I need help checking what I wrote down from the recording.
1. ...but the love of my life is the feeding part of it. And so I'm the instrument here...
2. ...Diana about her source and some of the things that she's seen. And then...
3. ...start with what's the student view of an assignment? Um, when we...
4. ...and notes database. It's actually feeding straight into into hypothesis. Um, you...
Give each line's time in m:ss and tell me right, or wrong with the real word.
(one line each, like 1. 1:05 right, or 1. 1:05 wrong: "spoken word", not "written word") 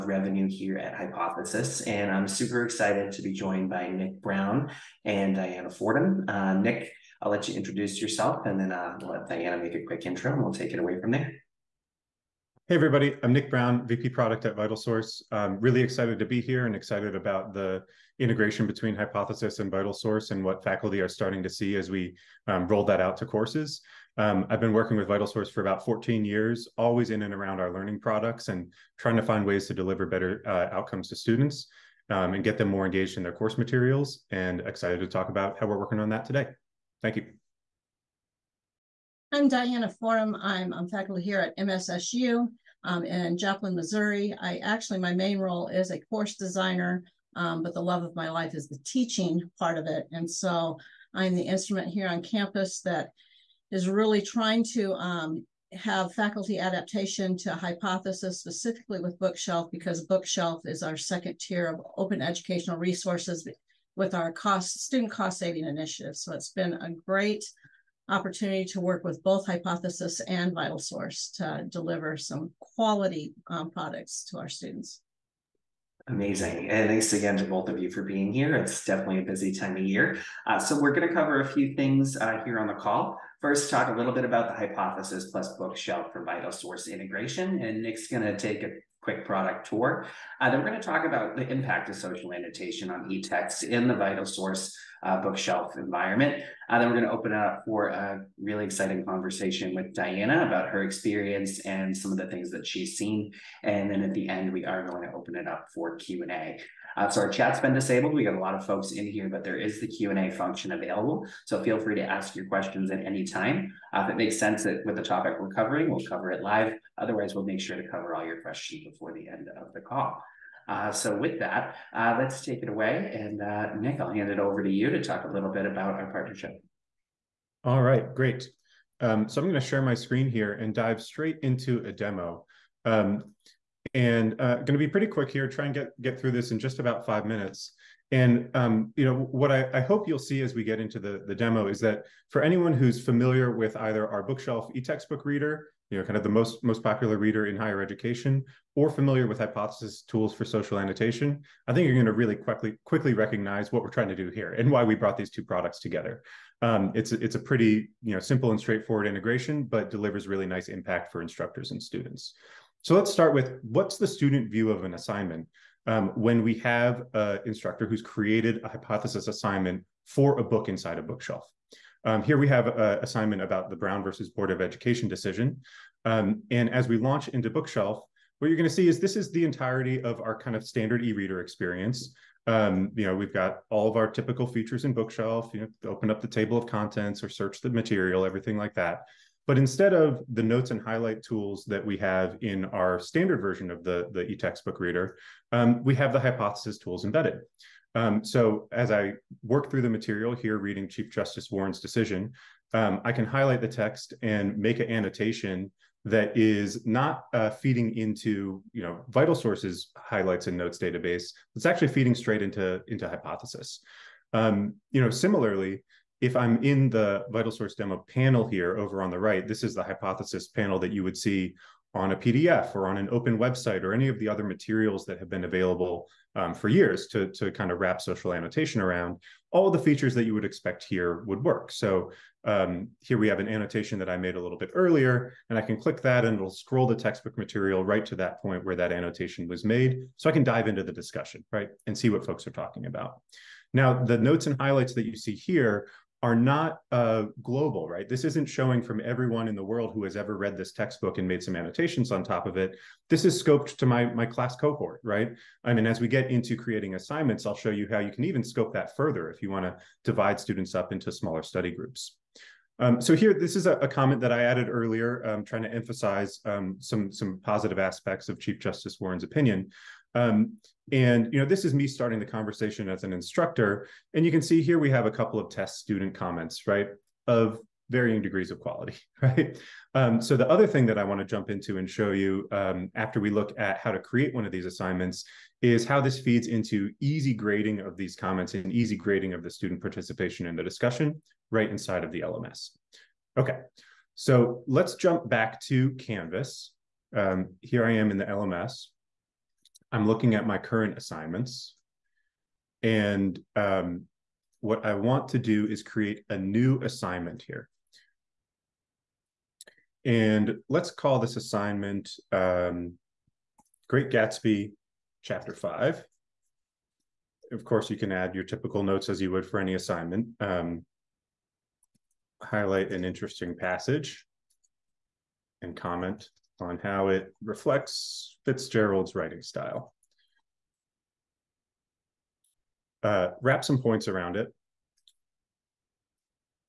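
1. 0:47 wrong: "teaching", not "feeding"
2. 1:39 wrong: "experience", not "source"
3. 2:43 right
4. 3:30 right.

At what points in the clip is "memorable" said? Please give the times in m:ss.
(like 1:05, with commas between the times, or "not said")
not said.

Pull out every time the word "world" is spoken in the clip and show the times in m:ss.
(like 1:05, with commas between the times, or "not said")
4:09.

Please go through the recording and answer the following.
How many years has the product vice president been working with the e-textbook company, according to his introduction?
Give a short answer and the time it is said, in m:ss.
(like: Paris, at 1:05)
14 years, at 0:25.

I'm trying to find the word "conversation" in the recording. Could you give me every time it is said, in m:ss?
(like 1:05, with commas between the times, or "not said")
1:39, 4:32.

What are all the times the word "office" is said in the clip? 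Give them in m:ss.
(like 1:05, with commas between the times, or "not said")
not said.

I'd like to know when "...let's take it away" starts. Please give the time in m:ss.
2:02.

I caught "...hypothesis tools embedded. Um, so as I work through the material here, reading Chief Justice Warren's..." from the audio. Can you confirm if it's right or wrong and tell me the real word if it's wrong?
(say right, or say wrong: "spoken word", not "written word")
right.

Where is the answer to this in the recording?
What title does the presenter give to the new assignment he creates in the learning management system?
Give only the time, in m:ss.
5:13.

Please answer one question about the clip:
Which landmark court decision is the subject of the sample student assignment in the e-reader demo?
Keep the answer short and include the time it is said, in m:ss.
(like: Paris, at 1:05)
Brown versus Board of Education, at 2:53.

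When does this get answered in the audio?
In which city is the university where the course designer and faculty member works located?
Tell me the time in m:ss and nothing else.
0:43.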